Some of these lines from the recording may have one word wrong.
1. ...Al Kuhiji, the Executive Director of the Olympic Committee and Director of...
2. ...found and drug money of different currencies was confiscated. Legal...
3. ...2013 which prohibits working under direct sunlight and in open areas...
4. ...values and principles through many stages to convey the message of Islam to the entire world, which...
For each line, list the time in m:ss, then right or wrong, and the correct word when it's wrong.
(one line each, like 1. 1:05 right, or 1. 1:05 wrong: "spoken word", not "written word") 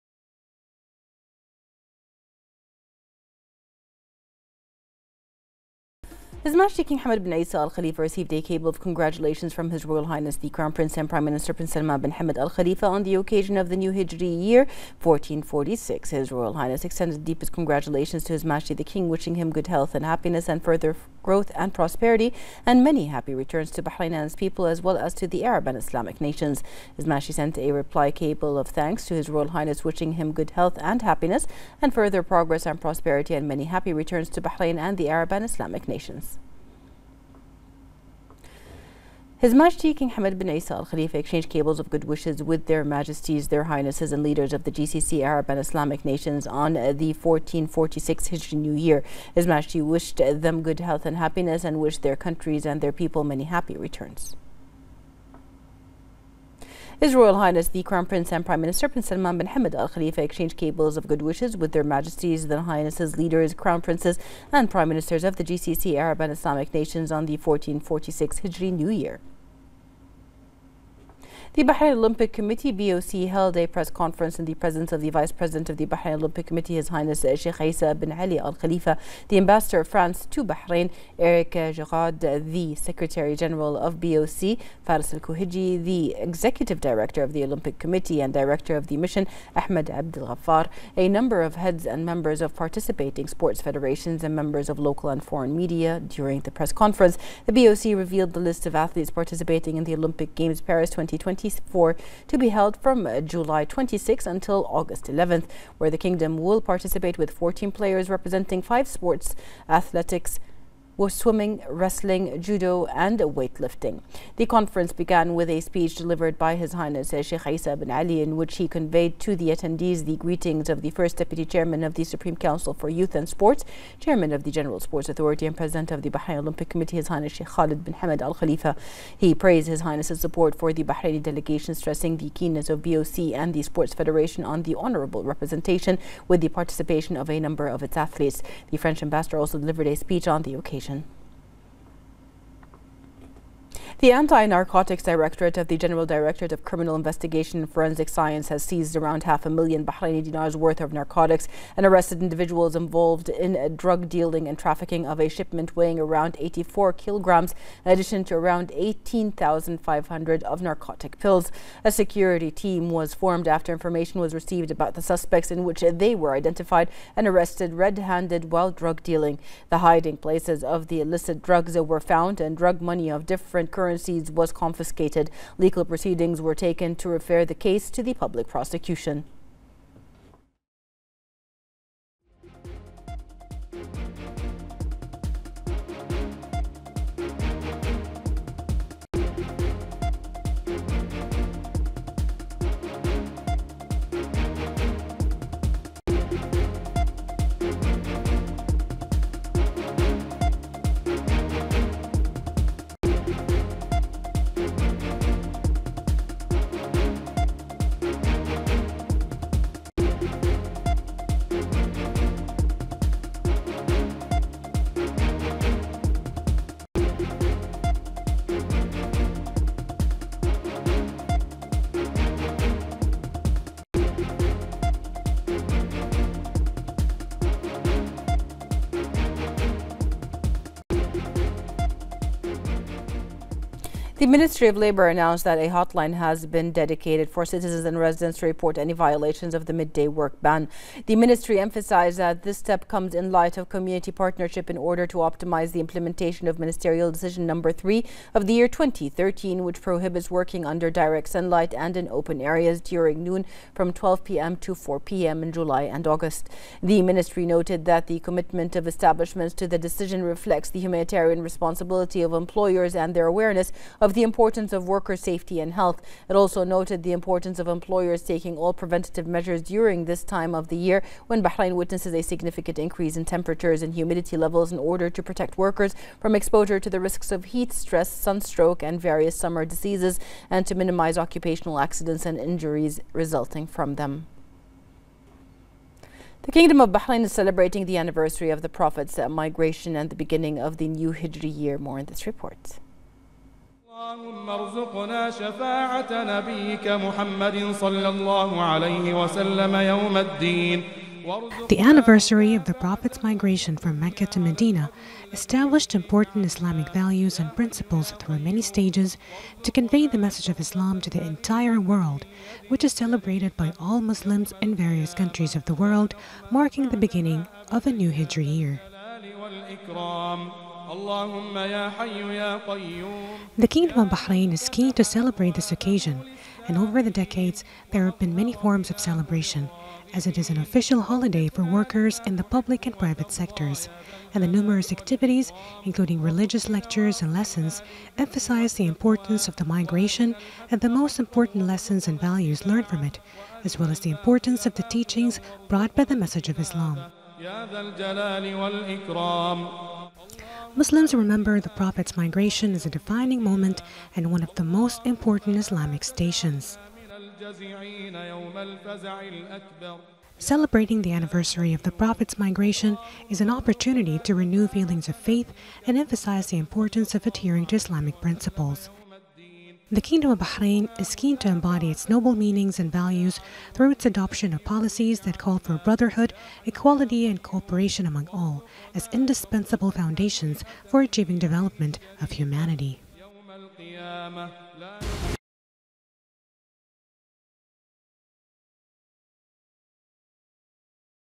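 1. 1:25 right
2. 2:51 right
3. 4:08 right
4. 5:06 right.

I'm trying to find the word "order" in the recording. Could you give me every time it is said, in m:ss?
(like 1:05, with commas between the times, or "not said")
4:04, 4:34.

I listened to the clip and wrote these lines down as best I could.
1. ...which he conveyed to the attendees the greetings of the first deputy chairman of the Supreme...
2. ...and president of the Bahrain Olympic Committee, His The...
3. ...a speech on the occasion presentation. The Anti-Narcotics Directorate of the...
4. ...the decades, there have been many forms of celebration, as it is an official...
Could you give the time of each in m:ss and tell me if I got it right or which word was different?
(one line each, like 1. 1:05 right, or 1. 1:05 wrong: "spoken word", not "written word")
1. 1:58 right
2. 2:05 wrong: "Highness", not "The"
3. 2:19 right
4. 5:27 right.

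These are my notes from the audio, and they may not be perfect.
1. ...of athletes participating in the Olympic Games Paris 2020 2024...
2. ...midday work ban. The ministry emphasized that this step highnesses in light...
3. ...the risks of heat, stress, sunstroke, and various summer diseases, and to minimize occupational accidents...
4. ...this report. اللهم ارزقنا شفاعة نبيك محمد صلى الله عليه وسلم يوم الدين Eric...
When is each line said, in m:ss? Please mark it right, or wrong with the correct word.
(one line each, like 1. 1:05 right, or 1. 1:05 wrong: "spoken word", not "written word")
1. 1:38 right
2. 3:59 wrong: "comes", not "highnesses"
3. 4:36 right
4. 4:52 wrong: "The", not "Eric".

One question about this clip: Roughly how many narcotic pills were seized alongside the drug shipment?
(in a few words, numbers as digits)
18,500.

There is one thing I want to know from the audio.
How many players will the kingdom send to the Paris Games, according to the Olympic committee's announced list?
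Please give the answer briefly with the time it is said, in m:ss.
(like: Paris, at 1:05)
14, at 1:47.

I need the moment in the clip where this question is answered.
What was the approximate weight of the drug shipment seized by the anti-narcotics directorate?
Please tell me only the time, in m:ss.
2:36.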